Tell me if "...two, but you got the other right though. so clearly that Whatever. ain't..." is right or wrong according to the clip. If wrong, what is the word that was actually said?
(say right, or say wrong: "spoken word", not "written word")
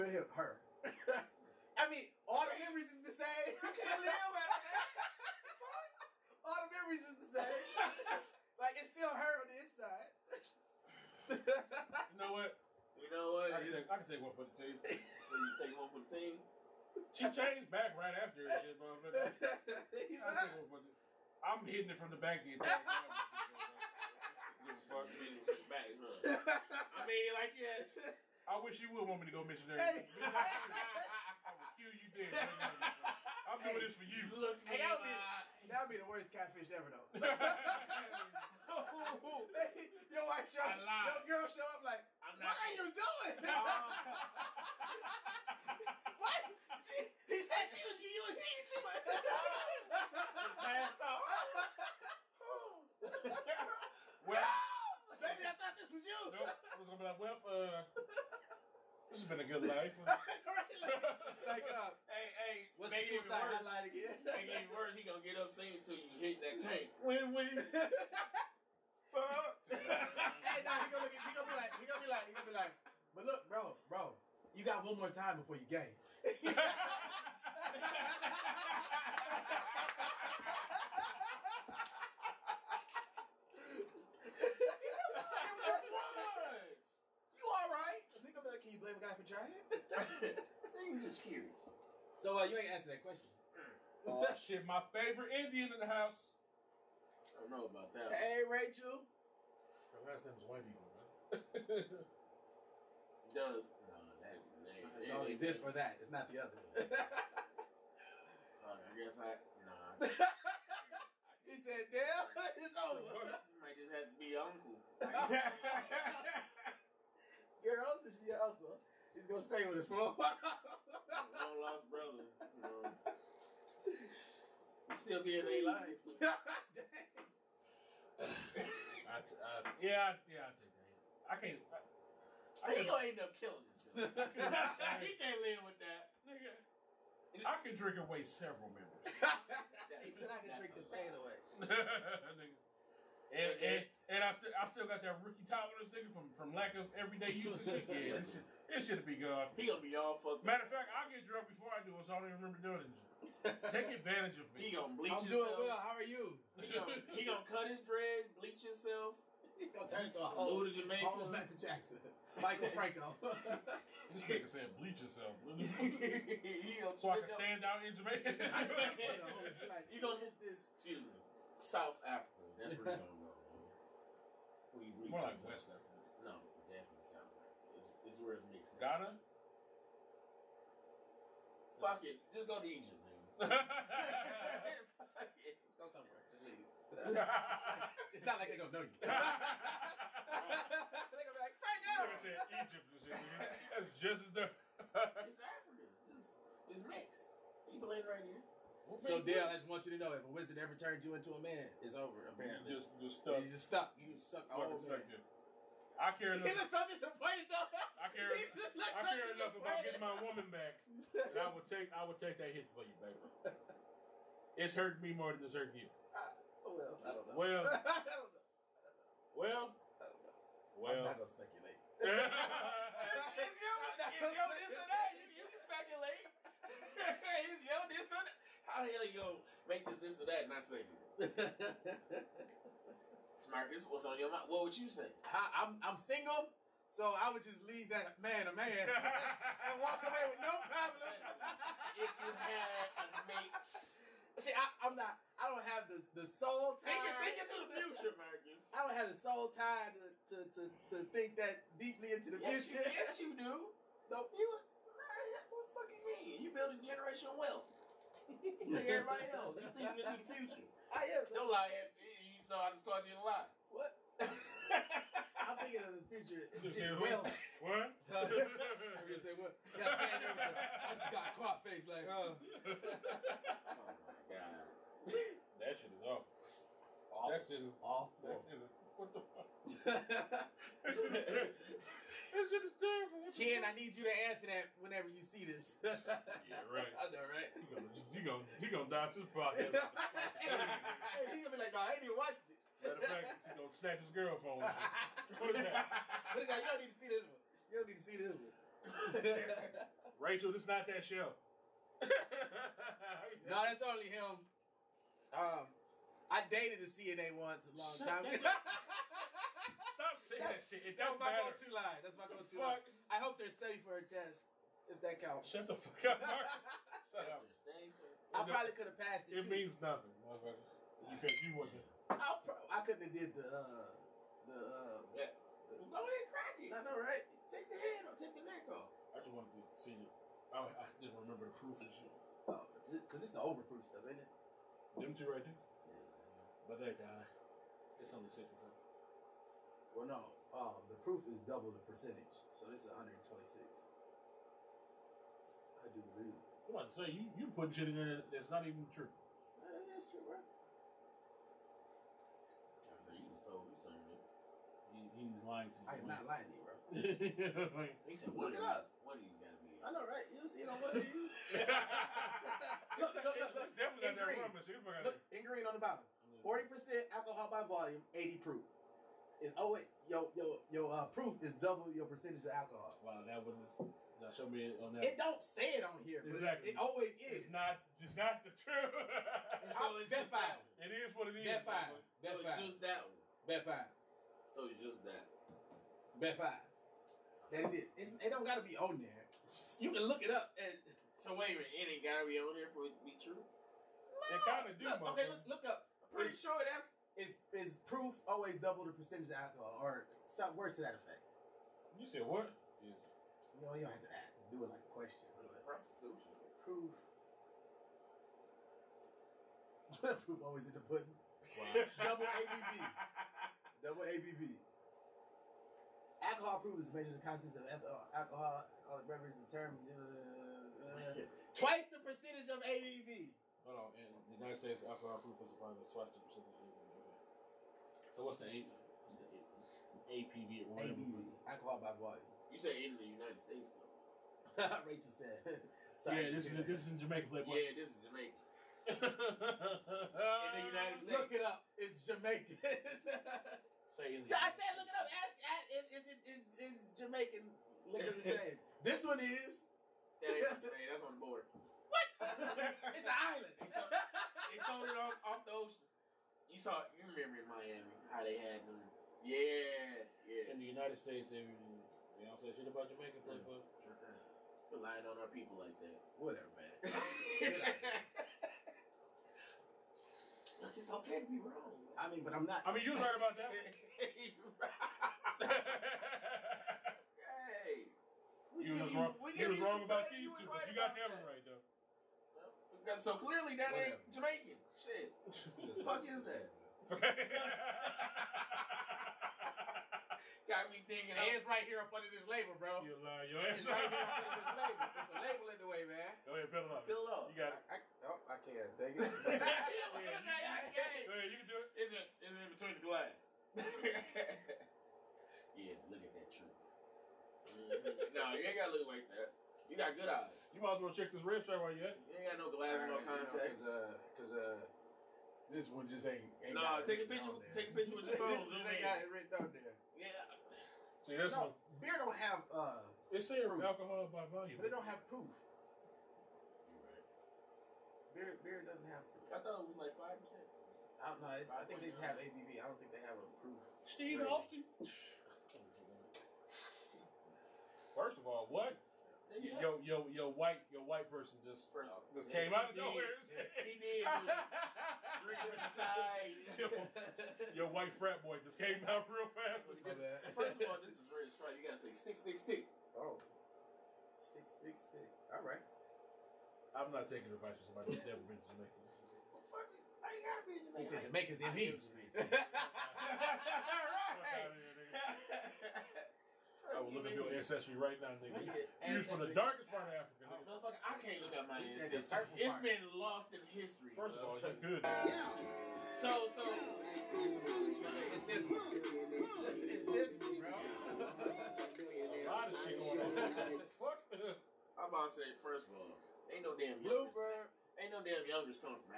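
right.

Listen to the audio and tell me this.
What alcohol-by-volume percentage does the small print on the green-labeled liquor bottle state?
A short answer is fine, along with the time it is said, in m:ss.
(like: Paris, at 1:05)
40 percent, at 6:06.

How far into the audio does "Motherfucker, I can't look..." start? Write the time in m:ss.
9:30.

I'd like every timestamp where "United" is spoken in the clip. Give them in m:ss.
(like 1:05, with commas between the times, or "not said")
7:04, 7:13, 7:20, 7:40.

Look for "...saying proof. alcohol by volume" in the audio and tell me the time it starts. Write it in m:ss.
8:43.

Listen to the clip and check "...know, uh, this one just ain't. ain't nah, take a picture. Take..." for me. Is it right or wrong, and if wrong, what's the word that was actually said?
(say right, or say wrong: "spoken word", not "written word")
right.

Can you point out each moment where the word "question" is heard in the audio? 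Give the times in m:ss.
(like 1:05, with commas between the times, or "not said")
1:33, 6:44.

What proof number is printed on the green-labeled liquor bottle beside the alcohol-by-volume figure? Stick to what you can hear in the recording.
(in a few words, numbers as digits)
80 proof.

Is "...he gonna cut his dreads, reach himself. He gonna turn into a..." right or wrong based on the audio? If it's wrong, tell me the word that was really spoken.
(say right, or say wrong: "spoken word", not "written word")
wrong: "bleach", not "reach".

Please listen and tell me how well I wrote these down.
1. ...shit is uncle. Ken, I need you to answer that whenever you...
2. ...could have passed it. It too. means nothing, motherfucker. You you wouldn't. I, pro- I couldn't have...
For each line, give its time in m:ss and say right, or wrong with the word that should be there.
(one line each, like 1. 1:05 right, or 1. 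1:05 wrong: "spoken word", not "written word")
1. 4:42 wrong: "terrible", not "uncle"
2. 5:18 right.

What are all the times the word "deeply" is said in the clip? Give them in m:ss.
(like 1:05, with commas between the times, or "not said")
4:11.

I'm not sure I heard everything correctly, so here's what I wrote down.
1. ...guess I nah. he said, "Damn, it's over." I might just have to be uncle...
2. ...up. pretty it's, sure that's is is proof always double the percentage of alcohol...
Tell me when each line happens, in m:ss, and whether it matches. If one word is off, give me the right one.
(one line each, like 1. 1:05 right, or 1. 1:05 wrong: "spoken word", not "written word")
1. 1:48 right
2. 6:35 right.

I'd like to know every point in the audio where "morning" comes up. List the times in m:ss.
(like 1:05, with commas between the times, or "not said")
not said.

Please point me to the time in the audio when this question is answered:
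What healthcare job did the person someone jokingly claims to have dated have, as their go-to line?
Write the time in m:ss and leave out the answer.
5:06.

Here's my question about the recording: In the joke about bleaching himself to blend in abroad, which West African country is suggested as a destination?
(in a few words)
Ghana.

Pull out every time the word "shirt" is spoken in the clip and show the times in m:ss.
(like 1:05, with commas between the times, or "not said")
8:31.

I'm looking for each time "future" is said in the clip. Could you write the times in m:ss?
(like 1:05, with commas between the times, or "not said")
4:07, 4:12, 4:20, 4:26.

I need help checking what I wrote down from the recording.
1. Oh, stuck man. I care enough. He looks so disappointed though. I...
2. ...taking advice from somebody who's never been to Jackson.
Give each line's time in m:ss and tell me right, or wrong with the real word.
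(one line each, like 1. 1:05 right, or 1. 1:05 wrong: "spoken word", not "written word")
1. 3:24 right
2. 9:17 wrong: "Jamaica", not "Jackson".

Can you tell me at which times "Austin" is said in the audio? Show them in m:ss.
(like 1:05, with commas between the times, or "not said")
8:54.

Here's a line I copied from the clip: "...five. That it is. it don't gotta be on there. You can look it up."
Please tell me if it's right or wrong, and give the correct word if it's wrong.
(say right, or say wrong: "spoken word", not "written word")
right.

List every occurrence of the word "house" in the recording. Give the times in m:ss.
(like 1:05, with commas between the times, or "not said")
1:35.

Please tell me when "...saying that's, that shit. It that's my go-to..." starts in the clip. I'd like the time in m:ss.
5:10.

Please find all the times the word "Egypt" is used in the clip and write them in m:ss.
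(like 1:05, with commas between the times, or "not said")
3:02, 3:12.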